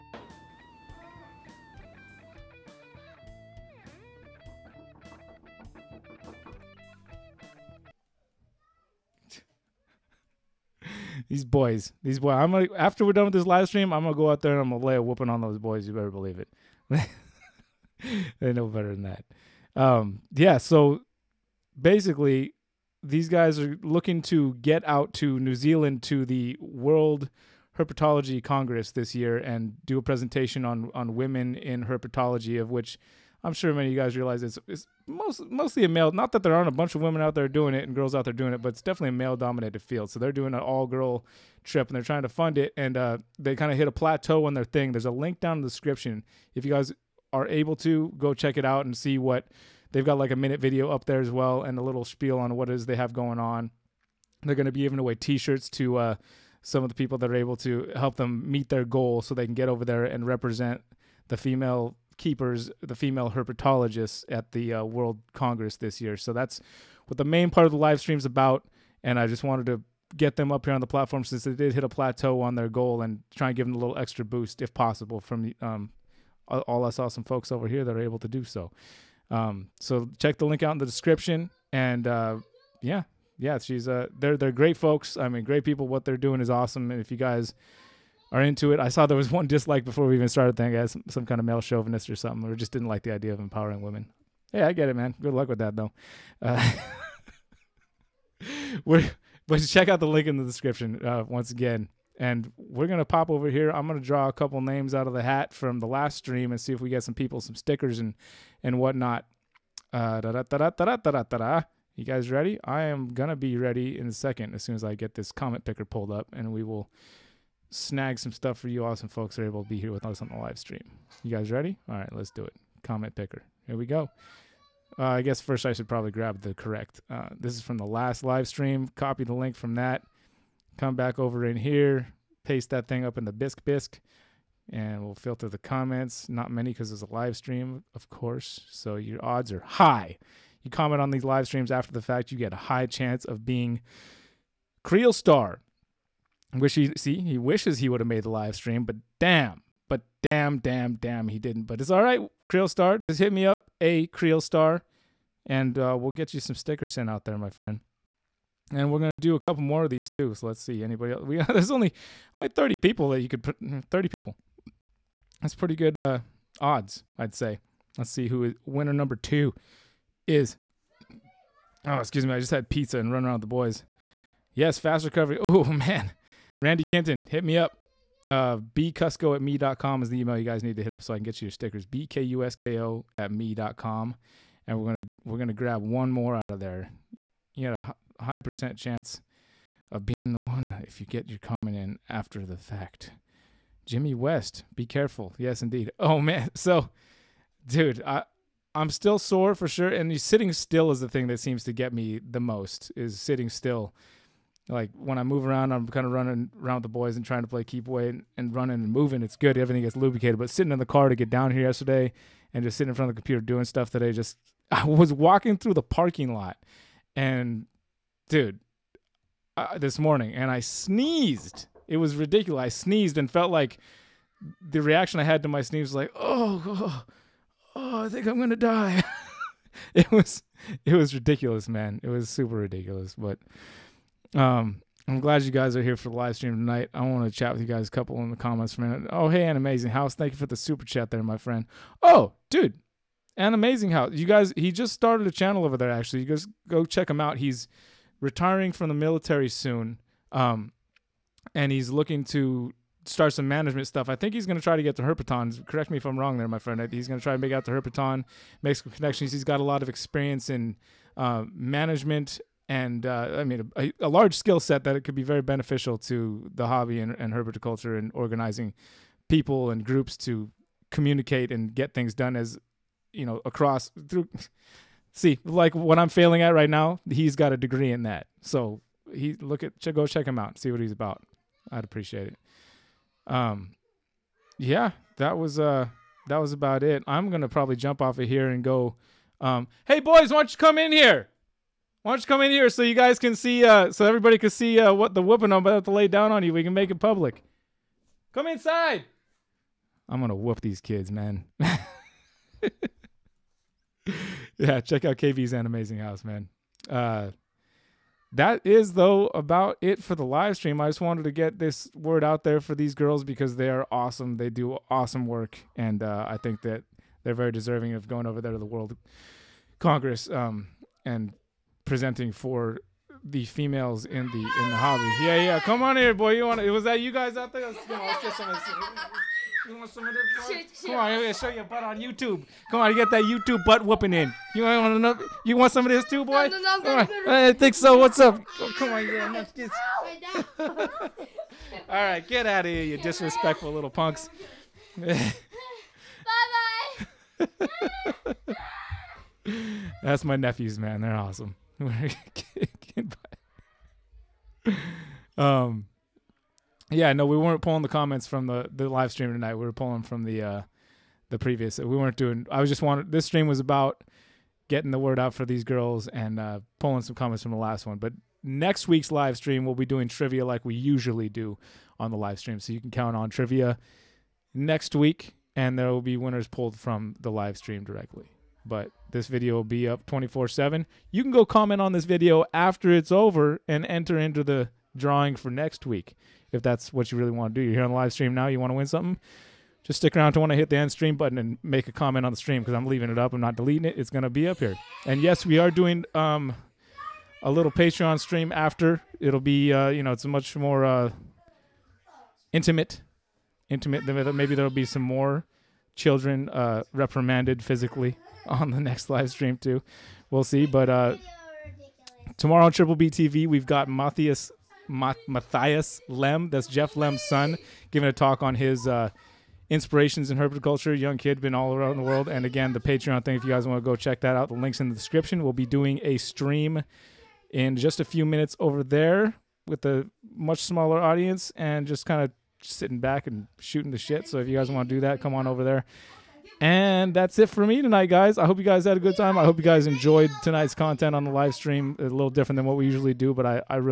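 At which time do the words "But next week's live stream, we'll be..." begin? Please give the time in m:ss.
6:07.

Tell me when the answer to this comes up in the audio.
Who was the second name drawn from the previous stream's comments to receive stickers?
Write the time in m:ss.
2:56.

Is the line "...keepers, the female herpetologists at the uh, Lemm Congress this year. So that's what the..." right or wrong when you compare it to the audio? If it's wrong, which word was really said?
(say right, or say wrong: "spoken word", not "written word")
wrong: "World", not "Lemm".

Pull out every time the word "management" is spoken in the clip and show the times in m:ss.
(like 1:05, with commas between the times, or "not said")
4:13, 4:21.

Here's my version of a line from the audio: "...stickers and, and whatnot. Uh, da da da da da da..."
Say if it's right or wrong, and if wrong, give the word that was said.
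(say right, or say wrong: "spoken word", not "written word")
right.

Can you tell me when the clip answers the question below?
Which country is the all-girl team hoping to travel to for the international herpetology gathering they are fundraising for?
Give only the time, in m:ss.
0:25.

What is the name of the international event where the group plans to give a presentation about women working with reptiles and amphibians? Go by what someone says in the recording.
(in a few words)
World Herpetology Congress.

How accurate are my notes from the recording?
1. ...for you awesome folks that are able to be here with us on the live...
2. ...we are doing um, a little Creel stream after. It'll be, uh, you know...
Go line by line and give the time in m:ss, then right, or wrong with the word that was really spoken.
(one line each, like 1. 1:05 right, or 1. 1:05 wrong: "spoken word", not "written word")
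1. 1:58 right
2. 6:35 wrong: "Patreon", not "Creel".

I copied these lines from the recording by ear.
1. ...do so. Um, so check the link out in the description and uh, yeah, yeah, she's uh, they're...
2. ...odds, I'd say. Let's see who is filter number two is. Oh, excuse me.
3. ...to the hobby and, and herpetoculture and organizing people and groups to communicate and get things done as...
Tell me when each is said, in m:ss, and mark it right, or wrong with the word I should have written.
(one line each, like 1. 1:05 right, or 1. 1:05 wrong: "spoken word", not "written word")
1. 1:18 right
2. 2:46 wrong: "winner", not "filter"
3. 4:25 right.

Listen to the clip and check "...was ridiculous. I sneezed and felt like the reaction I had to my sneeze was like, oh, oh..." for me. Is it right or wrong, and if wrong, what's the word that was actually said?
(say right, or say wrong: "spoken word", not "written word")
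right.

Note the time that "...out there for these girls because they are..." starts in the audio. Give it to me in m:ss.
5:12.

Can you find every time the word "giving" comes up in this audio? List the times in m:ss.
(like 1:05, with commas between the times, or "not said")
0:54, 6:57.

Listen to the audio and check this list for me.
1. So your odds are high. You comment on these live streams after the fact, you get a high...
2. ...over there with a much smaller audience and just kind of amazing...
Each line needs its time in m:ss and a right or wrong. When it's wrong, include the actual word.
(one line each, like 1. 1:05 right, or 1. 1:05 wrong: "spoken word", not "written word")
1. 2:18 right
2. 7:08 wrong: "sitting", not "amazing".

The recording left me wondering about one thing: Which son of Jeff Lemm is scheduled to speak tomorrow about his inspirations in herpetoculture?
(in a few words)
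Matthias Lemm.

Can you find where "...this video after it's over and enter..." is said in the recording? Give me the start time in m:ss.
6:21.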